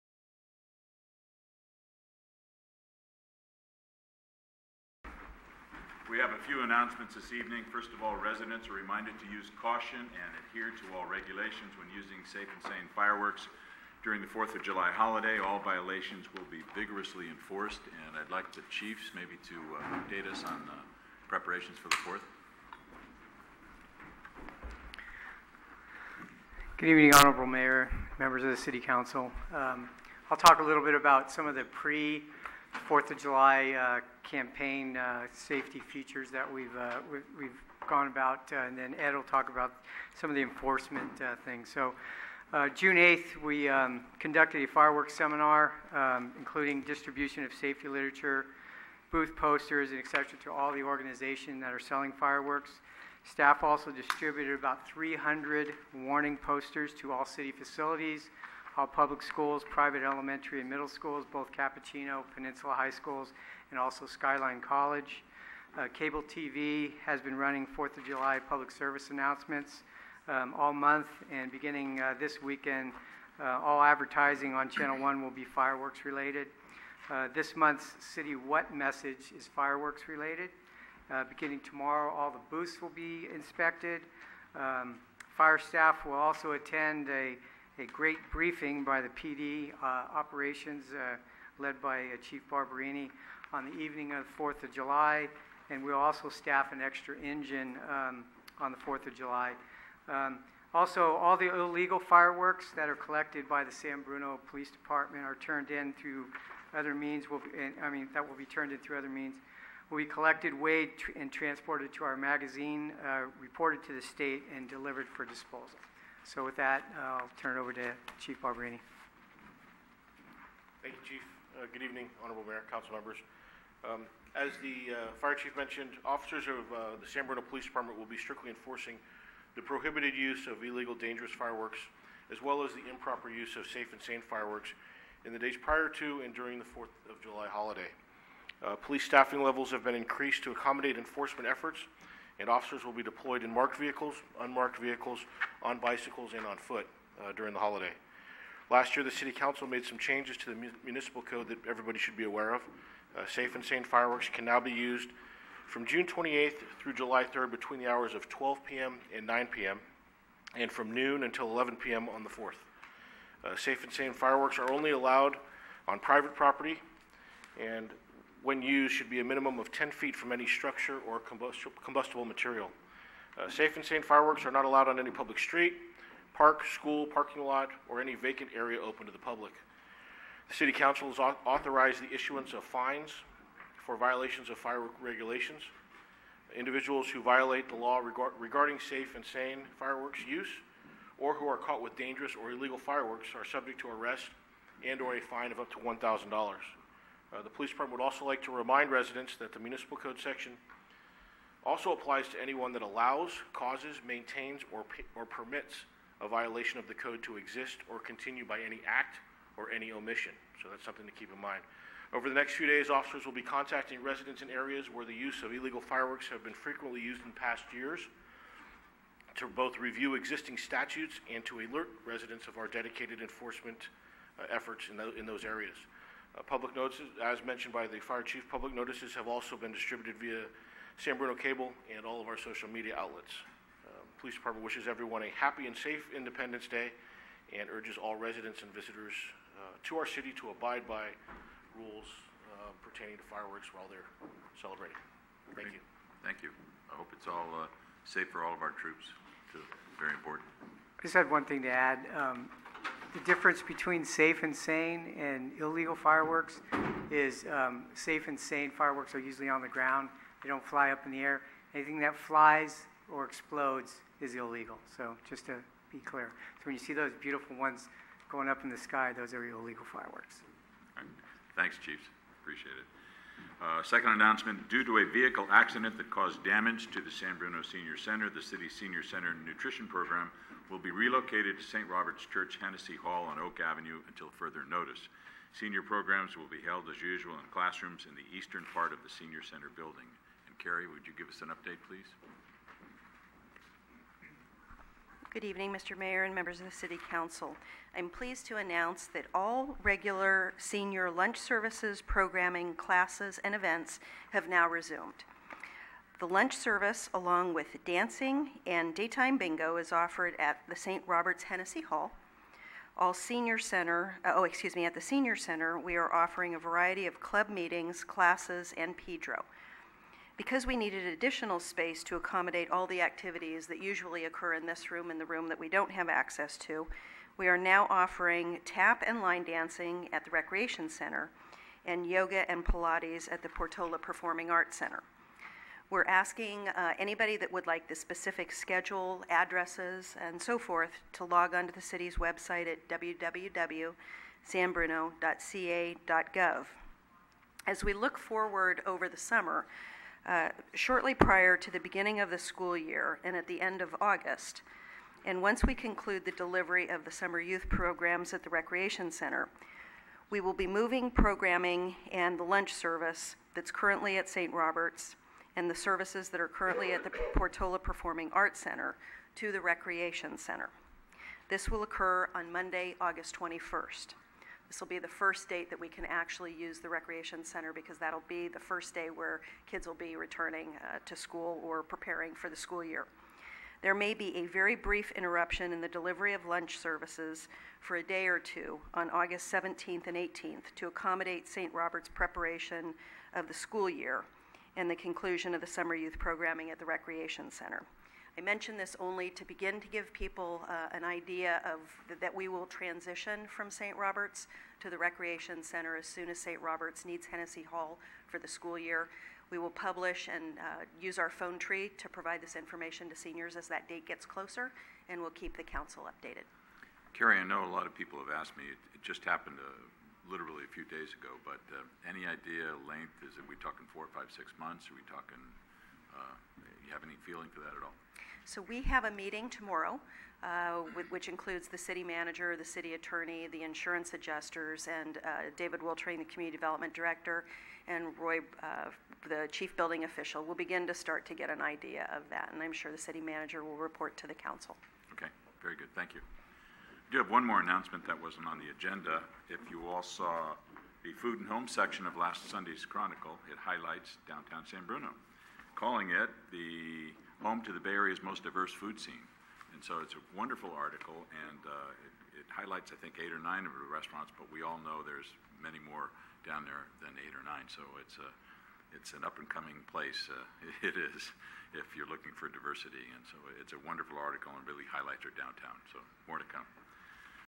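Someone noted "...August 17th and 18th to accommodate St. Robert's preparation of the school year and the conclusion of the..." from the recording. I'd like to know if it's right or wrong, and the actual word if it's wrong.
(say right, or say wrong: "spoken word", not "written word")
right.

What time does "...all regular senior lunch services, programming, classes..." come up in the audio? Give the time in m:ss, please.
4:59.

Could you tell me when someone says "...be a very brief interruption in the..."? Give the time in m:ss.
6:24.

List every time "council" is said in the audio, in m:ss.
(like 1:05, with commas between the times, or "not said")
0:28, 2:02, 2:29, 3:00, 4:57, 6:55, 7:24.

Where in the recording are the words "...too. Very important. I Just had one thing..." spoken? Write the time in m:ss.
4:09.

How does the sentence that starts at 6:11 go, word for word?
This will occur on Monday, August 21st.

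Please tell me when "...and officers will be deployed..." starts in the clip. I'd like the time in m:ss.
2:22.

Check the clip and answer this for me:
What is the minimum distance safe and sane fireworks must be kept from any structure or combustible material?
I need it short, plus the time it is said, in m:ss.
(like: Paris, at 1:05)
10 feet, at 2:49.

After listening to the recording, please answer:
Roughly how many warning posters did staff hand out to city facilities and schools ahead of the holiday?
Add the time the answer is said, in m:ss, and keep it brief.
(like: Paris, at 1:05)
300, at 0:54.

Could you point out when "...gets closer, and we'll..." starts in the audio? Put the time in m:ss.
6:54.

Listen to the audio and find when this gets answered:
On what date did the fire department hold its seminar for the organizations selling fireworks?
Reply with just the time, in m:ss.
0:42.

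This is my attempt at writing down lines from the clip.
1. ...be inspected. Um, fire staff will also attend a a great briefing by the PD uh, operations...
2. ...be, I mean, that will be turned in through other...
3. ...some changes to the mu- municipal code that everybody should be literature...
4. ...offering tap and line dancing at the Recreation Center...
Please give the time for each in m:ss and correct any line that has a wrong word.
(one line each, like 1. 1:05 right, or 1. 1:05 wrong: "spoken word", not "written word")
1. 1:22 right
2. 1:47 right
3. 2:29 wrong: "aware", not "literature"
4. 5:27 right.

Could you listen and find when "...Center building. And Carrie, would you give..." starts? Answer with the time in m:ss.
4:49.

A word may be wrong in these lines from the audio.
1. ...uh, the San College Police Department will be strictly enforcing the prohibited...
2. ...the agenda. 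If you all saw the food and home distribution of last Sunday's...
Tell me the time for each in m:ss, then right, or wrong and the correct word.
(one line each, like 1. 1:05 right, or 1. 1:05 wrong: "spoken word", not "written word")
1. 2:06 wrong: "Bruno", not "College"
2. 7:28 wrong: "section", not "distribution".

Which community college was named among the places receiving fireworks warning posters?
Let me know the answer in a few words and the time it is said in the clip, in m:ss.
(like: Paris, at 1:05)
Skyline College, at 1:04.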